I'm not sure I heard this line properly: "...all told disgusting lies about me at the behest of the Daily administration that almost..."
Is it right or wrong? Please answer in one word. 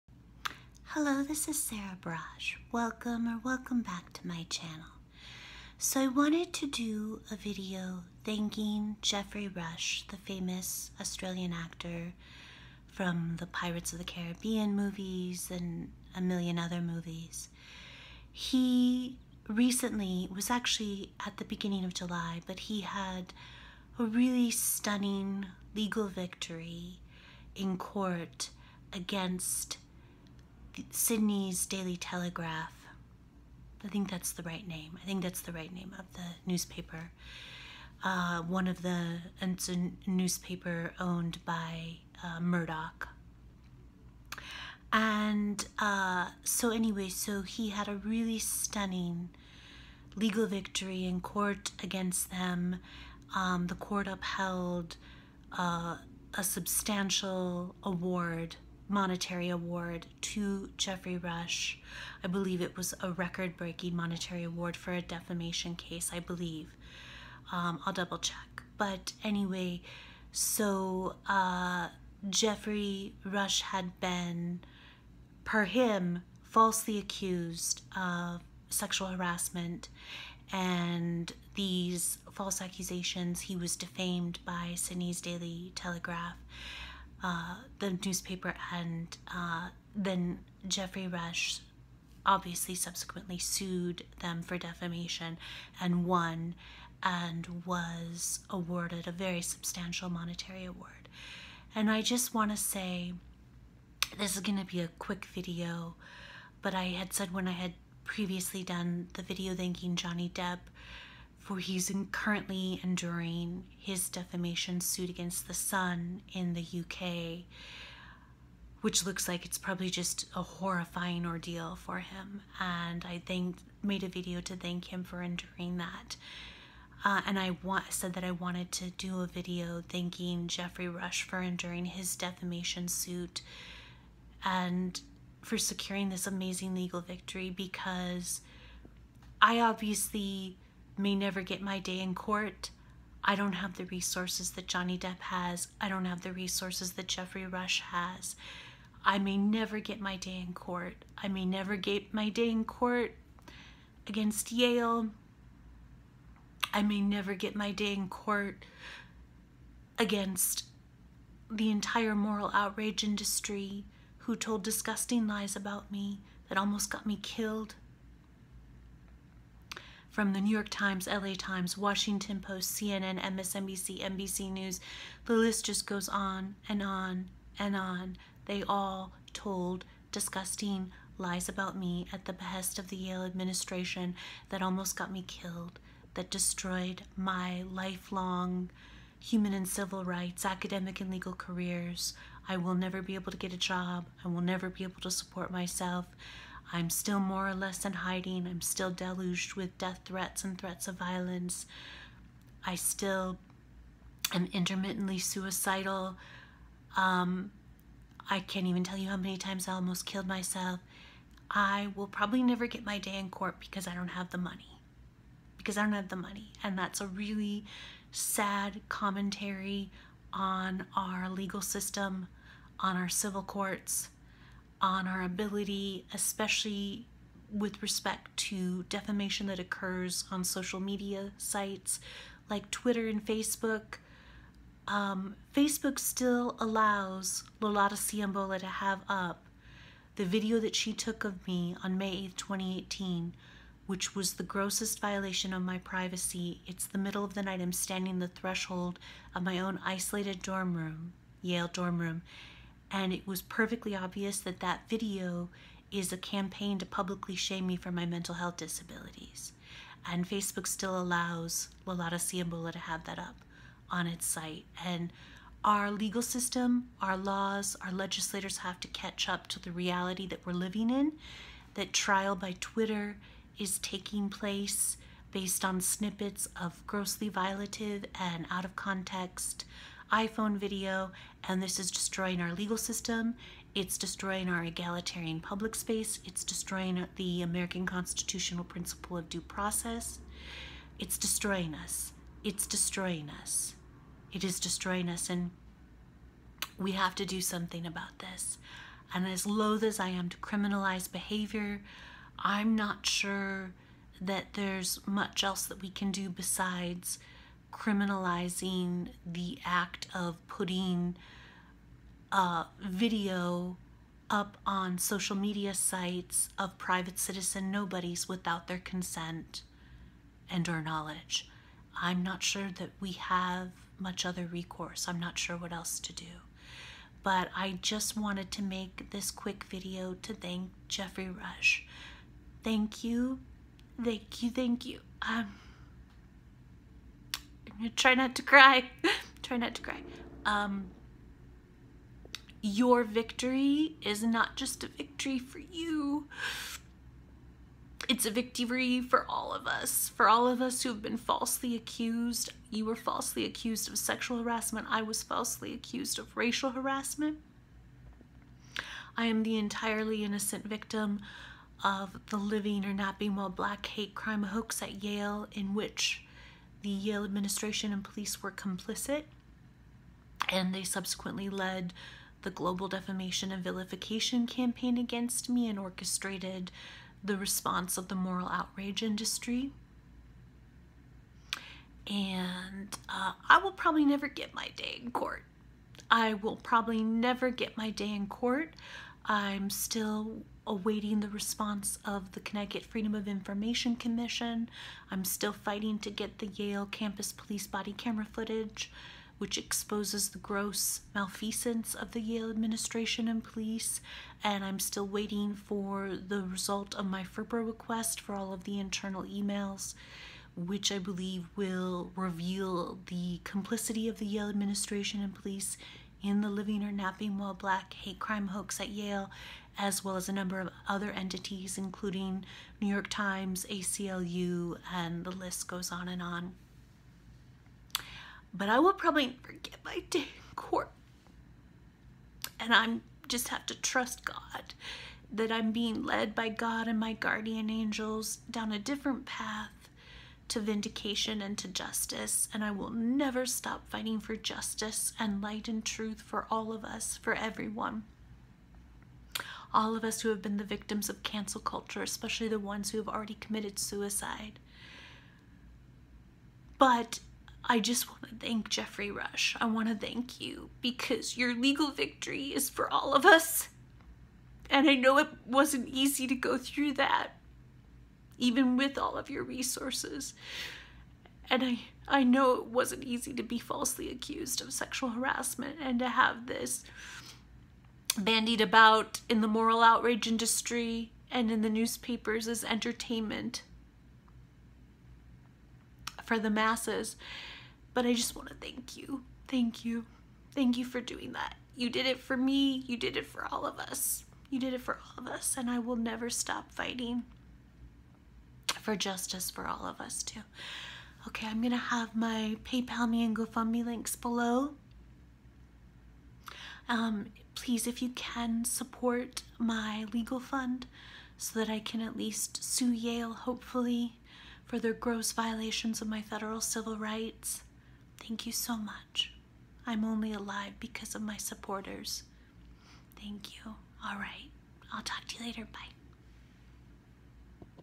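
wrong.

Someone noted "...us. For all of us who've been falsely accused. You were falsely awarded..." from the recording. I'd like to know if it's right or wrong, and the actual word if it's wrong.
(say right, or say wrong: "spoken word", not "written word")
wrong: "accused", not "awarded".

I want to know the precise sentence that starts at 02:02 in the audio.
And I think made a video to thank him for enduring that.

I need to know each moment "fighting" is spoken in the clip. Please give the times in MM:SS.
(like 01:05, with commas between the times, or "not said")
06:35, 07:23, 08:16.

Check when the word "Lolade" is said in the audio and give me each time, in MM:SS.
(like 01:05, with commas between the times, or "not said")
03:57, 04:21.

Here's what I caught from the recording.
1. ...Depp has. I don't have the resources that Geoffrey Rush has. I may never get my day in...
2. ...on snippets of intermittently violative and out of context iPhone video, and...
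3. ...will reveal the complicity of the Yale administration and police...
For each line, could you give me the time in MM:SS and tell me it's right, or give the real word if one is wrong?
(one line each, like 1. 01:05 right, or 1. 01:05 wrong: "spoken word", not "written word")
1. 02:24 right
2. 04:35 wrong: "grossly", not "intermittently"
3. 06:51 right.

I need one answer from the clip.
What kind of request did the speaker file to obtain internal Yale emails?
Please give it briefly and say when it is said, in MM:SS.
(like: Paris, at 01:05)
FERPA request, at 06:47.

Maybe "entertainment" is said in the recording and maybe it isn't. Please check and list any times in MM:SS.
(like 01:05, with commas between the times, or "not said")
08:02.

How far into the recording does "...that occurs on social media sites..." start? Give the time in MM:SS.
03:49.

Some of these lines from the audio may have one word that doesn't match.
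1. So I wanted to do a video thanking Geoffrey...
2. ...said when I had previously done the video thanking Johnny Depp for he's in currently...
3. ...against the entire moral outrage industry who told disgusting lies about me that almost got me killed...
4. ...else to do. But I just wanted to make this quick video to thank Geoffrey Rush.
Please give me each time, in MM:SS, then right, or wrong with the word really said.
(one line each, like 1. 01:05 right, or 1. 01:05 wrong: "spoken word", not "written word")
1. 00:05 right
2. 01:47 right
3. 02:39 right
4. 05:25 right.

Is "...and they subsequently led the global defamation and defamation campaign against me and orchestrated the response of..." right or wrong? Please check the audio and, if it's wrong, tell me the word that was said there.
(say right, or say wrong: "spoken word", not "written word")
wrong: "vilification", not "defamation".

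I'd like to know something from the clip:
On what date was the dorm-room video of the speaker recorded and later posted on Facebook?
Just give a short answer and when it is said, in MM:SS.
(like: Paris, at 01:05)
May 8, 2018, at 04:01.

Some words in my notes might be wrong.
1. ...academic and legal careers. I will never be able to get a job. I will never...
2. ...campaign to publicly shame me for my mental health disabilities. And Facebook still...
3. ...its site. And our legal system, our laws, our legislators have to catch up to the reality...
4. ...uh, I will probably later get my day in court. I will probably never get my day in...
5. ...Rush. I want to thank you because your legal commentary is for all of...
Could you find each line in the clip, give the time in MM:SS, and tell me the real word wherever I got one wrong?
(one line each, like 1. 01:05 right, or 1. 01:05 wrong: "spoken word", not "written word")
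1. 03:10 right
2. 04:16 right
3. 04:24 right
4. 06:23 wrong: "never", not "later"
5. 07:39 wrong: "victory", not "commentary".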